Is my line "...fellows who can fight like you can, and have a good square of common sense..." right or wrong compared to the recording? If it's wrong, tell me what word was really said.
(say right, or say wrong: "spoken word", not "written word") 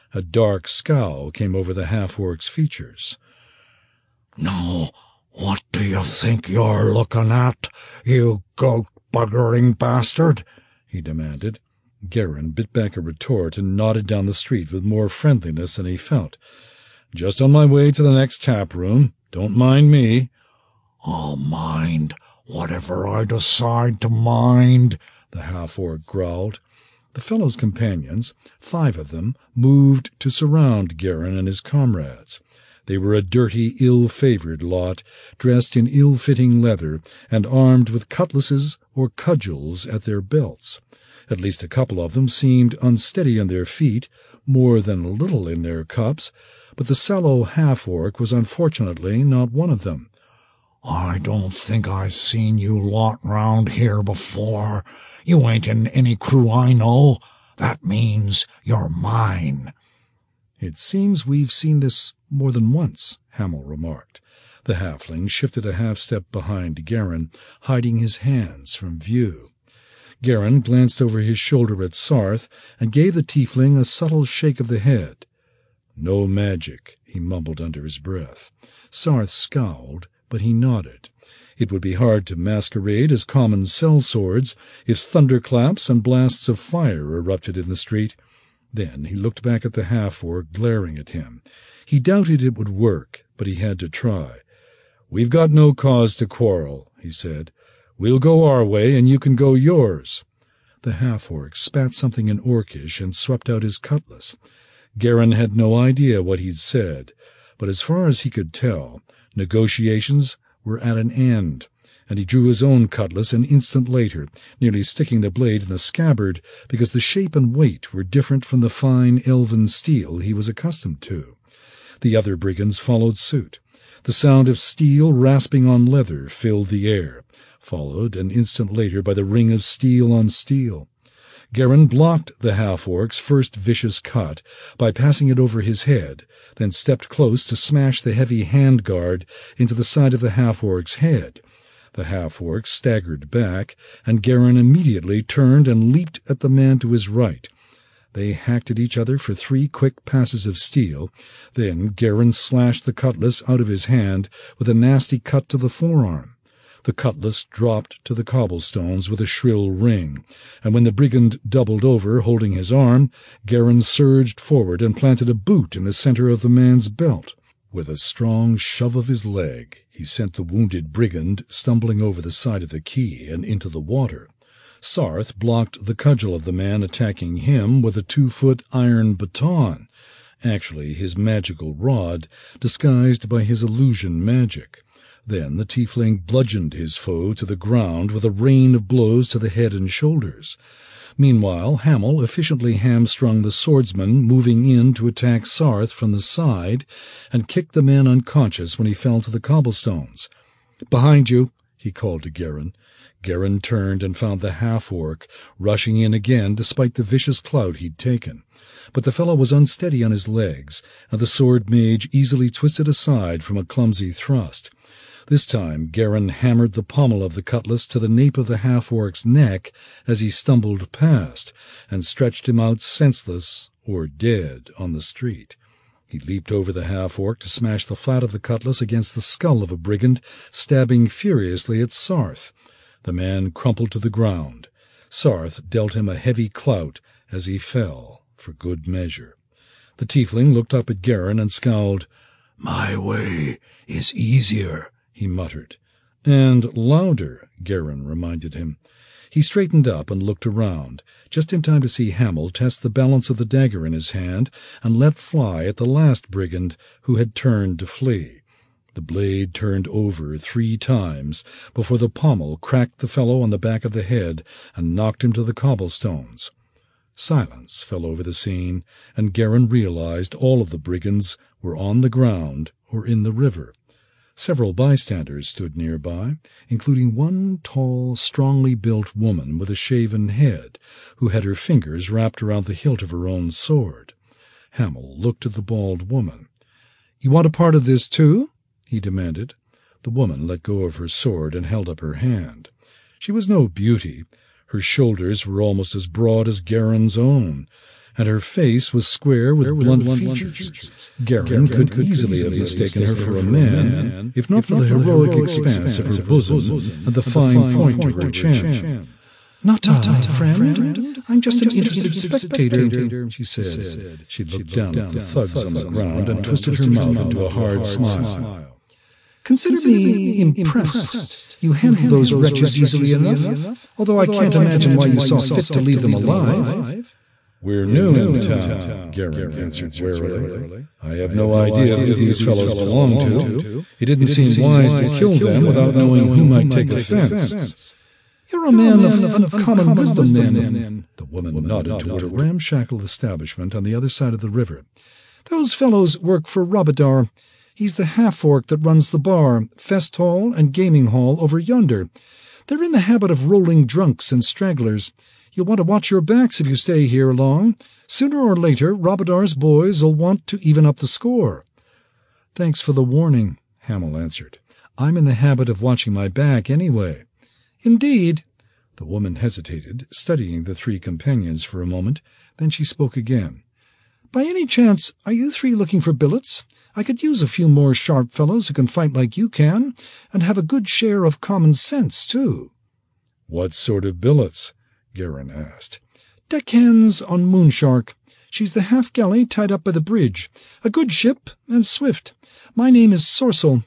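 wrong: "share", not "square".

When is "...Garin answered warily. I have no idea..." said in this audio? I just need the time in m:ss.
5:29.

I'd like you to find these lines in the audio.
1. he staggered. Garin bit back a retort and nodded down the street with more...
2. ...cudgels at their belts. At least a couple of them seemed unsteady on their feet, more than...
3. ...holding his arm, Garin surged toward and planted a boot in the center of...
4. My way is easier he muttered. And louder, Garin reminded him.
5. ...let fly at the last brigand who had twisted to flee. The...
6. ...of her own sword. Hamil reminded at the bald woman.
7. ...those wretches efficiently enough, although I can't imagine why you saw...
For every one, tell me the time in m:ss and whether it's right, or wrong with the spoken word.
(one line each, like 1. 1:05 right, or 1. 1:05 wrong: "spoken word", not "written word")
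1. 0:10 wrong: "demanded", not "staggered"
2. 0:39 right
3. 2:42 wrong: "forward", not "toward"
4. 4:02 right
5. 4:14 wrong: "turned", not "twisted"
6. 4:43 wrong: "looked", not "reminded"
7. 5:22 wrong: "easily", not "efficiently".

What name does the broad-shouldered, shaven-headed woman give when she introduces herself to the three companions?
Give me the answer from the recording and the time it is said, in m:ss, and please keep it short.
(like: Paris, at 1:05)
Sorcel, at 6:33.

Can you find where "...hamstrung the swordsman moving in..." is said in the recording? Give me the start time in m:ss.
3:12.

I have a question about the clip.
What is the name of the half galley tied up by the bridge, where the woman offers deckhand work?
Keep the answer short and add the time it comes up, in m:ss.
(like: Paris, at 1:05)
Moonshark, at 6:27.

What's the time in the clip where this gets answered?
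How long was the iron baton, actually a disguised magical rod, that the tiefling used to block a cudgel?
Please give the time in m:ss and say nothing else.
2:58.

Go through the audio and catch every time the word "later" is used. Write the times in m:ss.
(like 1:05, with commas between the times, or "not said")
1:53, 2:08, 5:58.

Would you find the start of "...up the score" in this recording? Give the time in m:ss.
6:00.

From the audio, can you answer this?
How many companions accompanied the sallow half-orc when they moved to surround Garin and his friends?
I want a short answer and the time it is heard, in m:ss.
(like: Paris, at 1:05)
5, at 0:28.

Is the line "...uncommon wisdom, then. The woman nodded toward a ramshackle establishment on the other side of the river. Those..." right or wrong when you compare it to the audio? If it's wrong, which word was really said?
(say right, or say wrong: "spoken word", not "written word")
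right.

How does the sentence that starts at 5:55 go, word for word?
You'll want to watch your backs if you stay here long.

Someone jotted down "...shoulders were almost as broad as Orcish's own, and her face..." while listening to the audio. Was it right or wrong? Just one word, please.
wrong.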